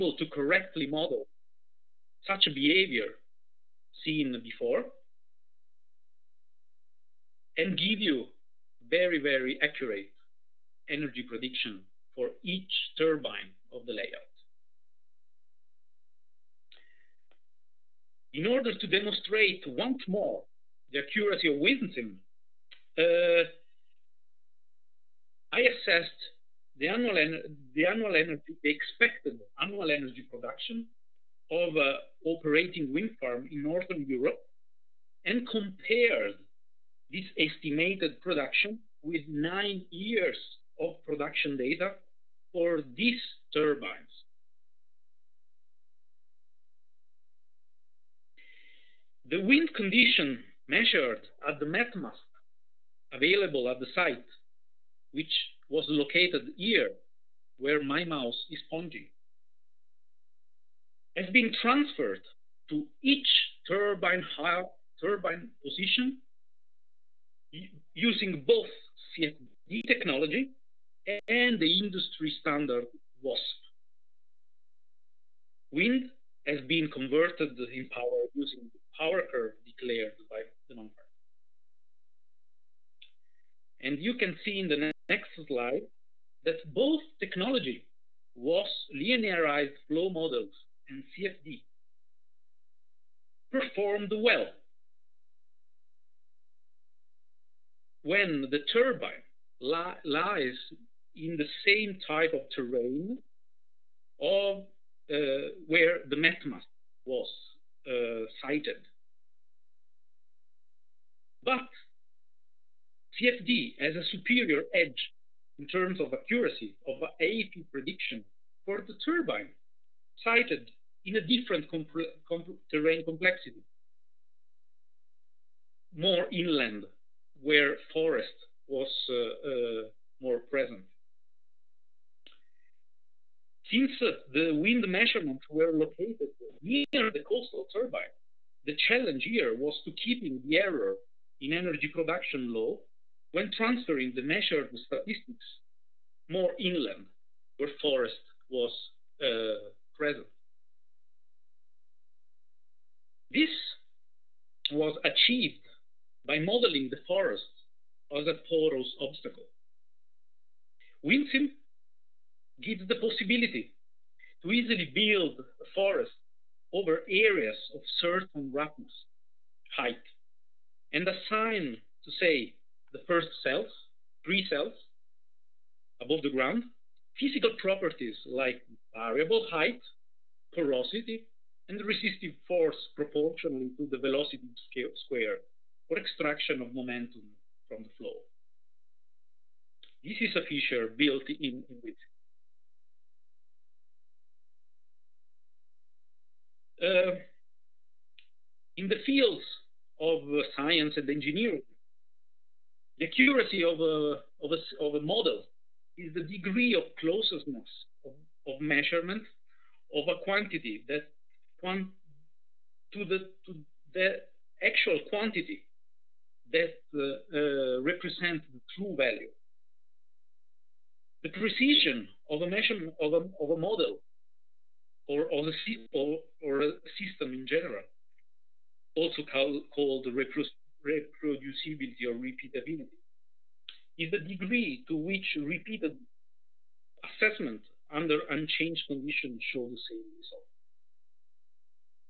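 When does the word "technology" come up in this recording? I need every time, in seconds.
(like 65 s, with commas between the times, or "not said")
69 s, 87 s.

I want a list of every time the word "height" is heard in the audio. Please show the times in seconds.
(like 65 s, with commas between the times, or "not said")
169 s, 179 s.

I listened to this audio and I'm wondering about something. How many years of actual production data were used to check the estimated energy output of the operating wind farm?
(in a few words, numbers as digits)
9.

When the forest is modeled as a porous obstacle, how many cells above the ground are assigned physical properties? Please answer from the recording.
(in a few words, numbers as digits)
3.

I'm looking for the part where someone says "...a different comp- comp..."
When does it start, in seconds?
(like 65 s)
121 s.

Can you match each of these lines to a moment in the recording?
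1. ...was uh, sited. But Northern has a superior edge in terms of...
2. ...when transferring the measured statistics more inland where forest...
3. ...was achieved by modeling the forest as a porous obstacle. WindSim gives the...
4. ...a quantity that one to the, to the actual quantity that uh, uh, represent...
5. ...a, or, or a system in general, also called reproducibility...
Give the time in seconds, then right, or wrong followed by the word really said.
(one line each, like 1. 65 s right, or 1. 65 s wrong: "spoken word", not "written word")
1. 107 s wrong: "CFD", not "Northern"
2. 143 s right
3. 154 s right
4. 210 s right
5. 225 s right.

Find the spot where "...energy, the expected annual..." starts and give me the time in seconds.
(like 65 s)
28 s.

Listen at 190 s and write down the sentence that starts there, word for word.
This is a feature built in, in with.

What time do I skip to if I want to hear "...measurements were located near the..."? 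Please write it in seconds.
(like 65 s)
134 s.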